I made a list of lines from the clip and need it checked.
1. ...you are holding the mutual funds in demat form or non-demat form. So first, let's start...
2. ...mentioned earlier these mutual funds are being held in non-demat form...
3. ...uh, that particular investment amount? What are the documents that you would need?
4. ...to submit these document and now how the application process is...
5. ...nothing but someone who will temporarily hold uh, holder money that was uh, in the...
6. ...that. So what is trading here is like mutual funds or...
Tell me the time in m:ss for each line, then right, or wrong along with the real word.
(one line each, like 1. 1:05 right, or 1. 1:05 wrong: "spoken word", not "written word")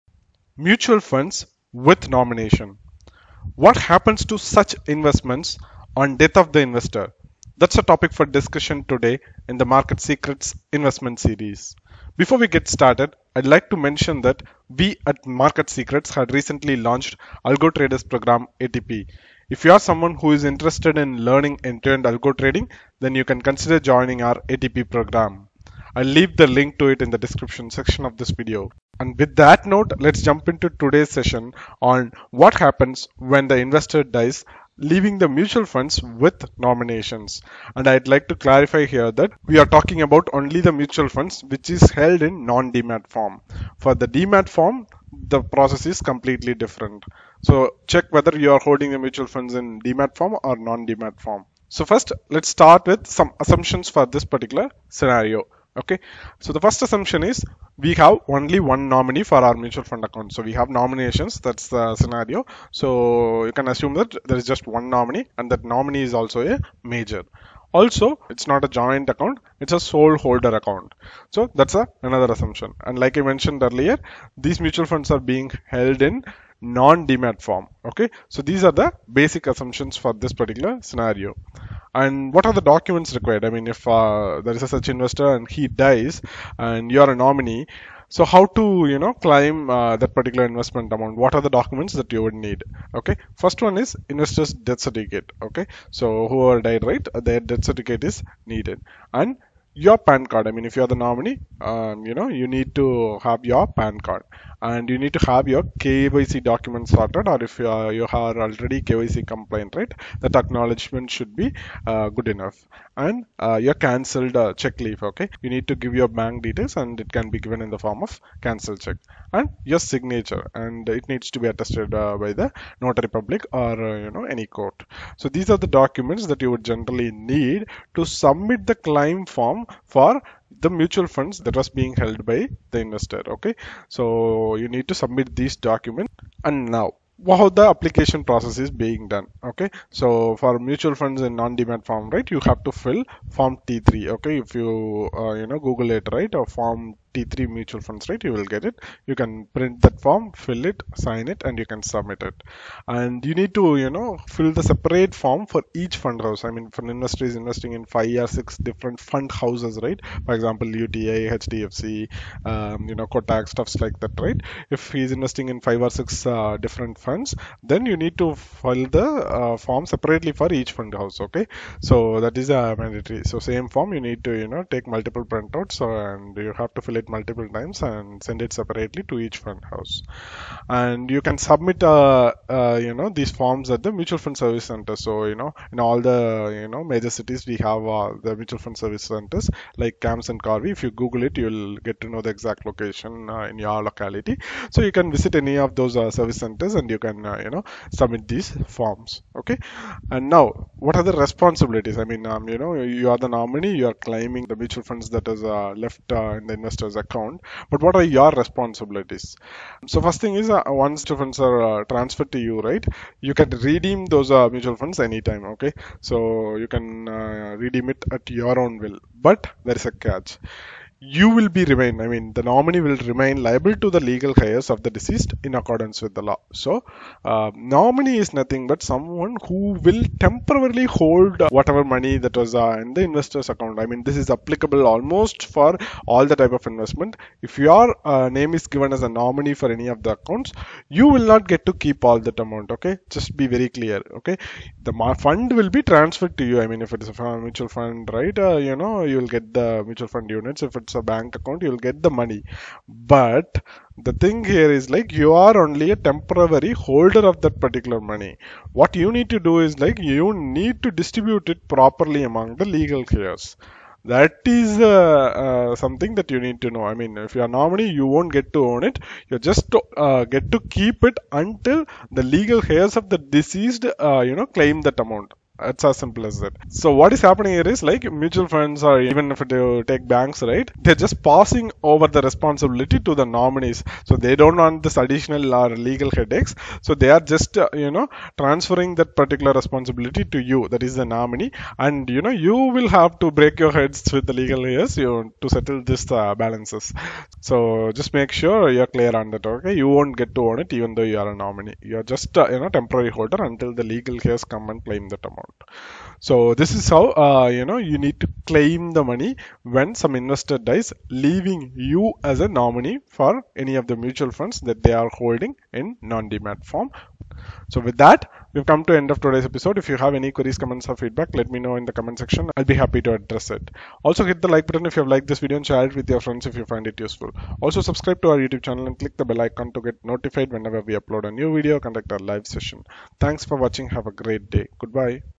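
1. 0:48 right
2. 1:13 right
3. 1:29 right
4. 2:14 right
5. 3:48 wrong: "whatever", not "holder"
6. 4:36 wrong: "happening", not "trading".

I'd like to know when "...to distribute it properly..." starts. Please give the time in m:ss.
4:20.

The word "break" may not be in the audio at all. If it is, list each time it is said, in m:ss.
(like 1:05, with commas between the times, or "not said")
4:53.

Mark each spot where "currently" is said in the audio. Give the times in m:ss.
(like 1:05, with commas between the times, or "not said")
not said.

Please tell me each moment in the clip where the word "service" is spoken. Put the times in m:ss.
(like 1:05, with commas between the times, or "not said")
3:04, 3:08, 3:16.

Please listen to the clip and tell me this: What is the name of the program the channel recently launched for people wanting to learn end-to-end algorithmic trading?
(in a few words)
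Algo Traders Program.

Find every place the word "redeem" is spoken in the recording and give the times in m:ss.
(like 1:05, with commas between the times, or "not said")
3:33, 3:37.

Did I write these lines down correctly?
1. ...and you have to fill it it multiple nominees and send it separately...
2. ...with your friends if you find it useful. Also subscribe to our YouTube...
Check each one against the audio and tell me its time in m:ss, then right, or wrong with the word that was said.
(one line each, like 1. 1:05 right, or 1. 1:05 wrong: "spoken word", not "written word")
1. 2:56 wrong: "times", not "nominees"
2. 5:25 right.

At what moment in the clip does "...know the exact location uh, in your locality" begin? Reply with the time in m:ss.
3:12.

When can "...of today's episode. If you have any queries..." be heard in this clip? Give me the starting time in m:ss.
5:19.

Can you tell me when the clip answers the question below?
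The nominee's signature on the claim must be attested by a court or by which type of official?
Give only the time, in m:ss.
2:02.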